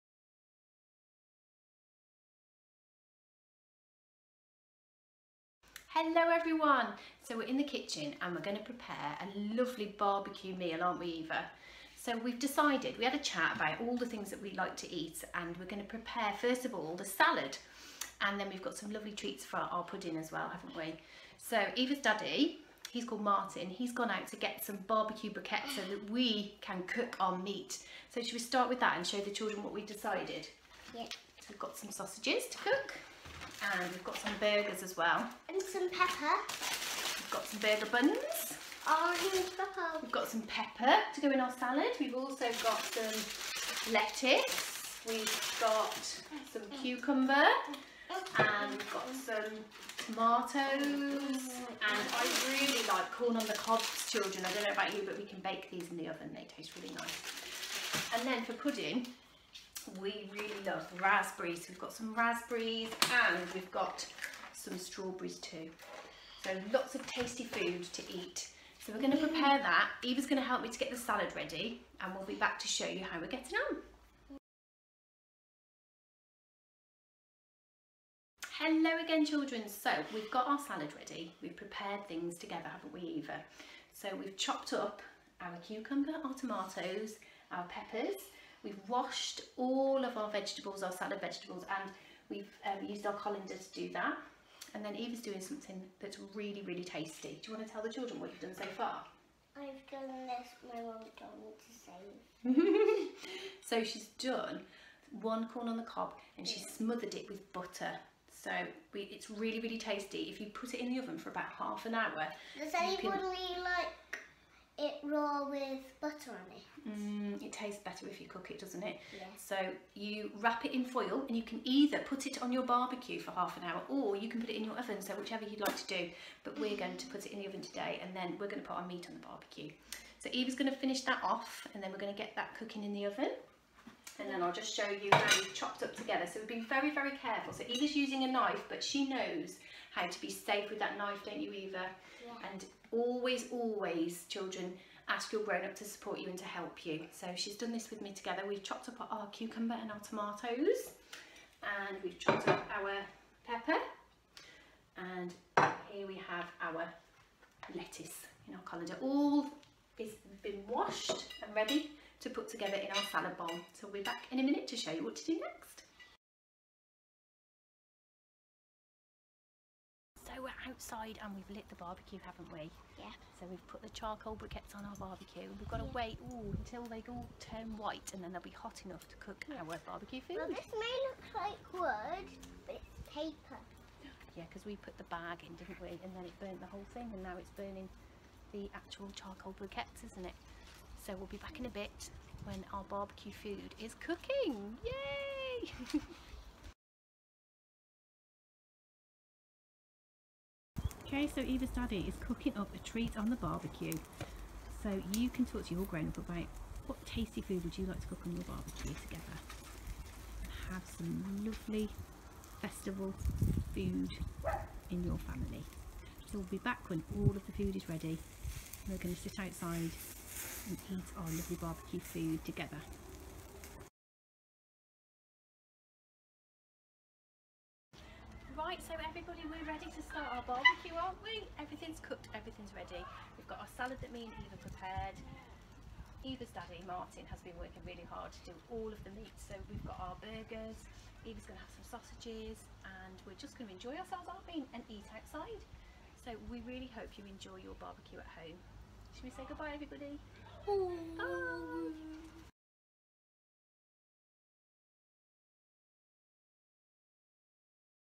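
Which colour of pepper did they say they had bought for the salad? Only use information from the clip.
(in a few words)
Orange.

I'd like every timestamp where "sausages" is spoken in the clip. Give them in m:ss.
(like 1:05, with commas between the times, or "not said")
0:31, 4:01.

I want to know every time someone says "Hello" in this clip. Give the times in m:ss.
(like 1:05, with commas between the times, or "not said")
0:05, 1:18.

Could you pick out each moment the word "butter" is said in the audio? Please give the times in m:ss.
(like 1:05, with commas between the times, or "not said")
1:47, 1:56.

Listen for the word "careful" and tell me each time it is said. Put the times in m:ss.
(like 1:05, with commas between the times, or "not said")
2:17.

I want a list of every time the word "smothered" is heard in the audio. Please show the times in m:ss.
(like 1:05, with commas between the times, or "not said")
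1:46.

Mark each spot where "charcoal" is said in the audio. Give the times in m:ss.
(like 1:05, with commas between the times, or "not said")
2:53, 3:09.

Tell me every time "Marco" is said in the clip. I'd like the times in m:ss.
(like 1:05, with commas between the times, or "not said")
not said.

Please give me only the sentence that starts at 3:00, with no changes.
Well, this may look like wood, but it's paper.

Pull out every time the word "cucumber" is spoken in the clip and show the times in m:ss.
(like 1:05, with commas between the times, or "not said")
0:46, 1:25, 2:29.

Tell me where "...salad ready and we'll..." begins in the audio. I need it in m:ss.
1:10.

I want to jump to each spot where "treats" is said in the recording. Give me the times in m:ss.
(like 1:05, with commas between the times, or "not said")
0:19, 3:22.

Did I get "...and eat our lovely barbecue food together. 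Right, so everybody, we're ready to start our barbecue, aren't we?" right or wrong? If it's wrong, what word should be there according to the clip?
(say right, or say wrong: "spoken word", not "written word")
right.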